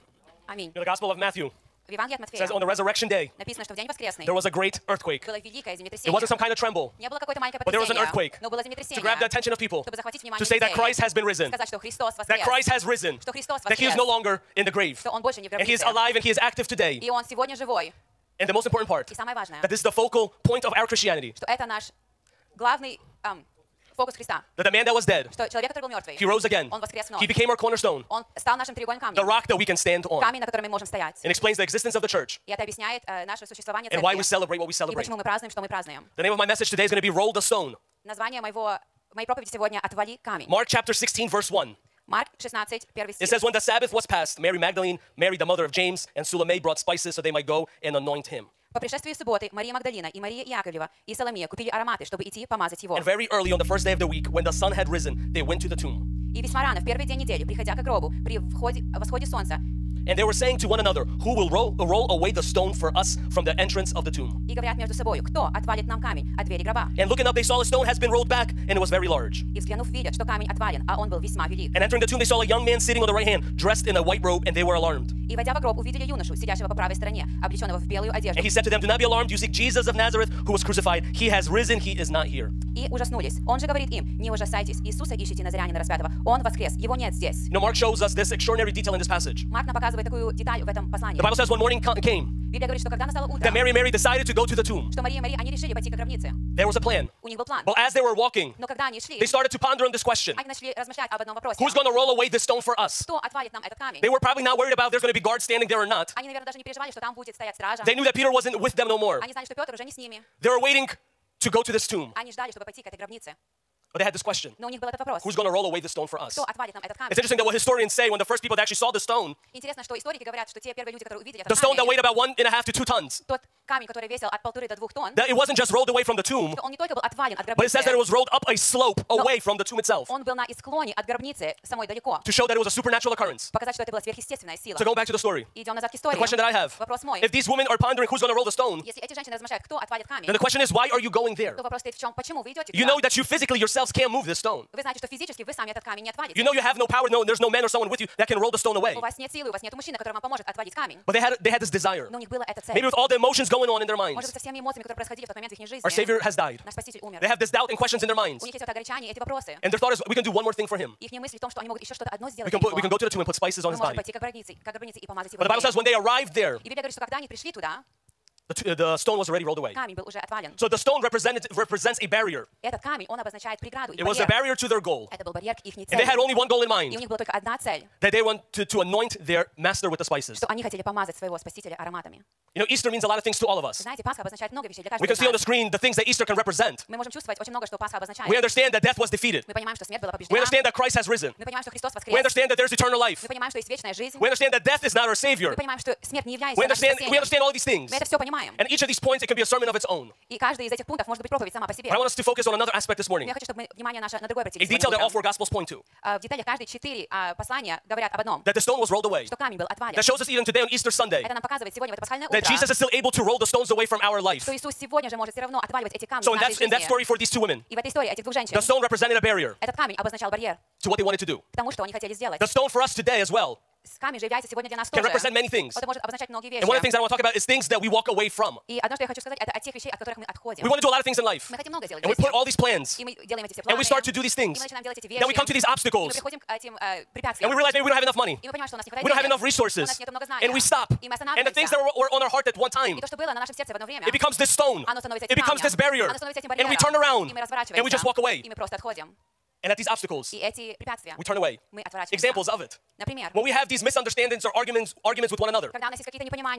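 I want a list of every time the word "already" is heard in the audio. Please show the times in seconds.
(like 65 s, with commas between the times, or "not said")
169 s.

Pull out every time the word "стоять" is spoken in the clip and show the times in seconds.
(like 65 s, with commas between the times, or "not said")
30 s, 107 s.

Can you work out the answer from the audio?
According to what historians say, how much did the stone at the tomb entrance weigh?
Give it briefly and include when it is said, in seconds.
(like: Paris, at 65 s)
1.5 to 2 tons, at 122 s.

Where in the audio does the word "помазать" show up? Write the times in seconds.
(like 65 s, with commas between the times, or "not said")
52 s, 165 s, 180 s.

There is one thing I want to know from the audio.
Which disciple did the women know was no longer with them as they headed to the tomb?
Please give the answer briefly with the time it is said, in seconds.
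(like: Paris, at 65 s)
Peter, at 108 s.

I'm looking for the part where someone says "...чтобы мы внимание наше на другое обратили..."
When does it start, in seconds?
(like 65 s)
203 s.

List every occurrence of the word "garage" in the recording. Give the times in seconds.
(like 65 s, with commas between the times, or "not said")
not said.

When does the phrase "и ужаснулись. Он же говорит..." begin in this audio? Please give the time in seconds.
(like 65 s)
82 s.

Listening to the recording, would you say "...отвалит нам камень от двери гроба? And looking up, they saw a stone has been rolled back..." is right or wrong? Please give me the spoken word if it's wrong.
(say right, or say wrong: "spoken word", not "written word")
right.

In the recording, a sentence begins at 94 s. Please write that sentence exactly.
что Мария и Мария, они решили пойти к гробнице.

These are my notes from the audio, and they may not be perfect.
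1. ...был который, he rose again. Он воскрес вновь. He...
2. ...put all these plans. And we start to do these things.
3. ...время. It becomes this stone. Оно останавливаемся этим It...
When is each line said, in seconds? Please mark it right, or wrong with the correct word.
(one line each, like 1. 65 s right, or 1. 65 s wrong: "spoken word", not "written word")
1. 25 s wrong: "мертвый", not "который"
2. 232 s right
3. 243 s wrong: "становится", not "останавливаемся".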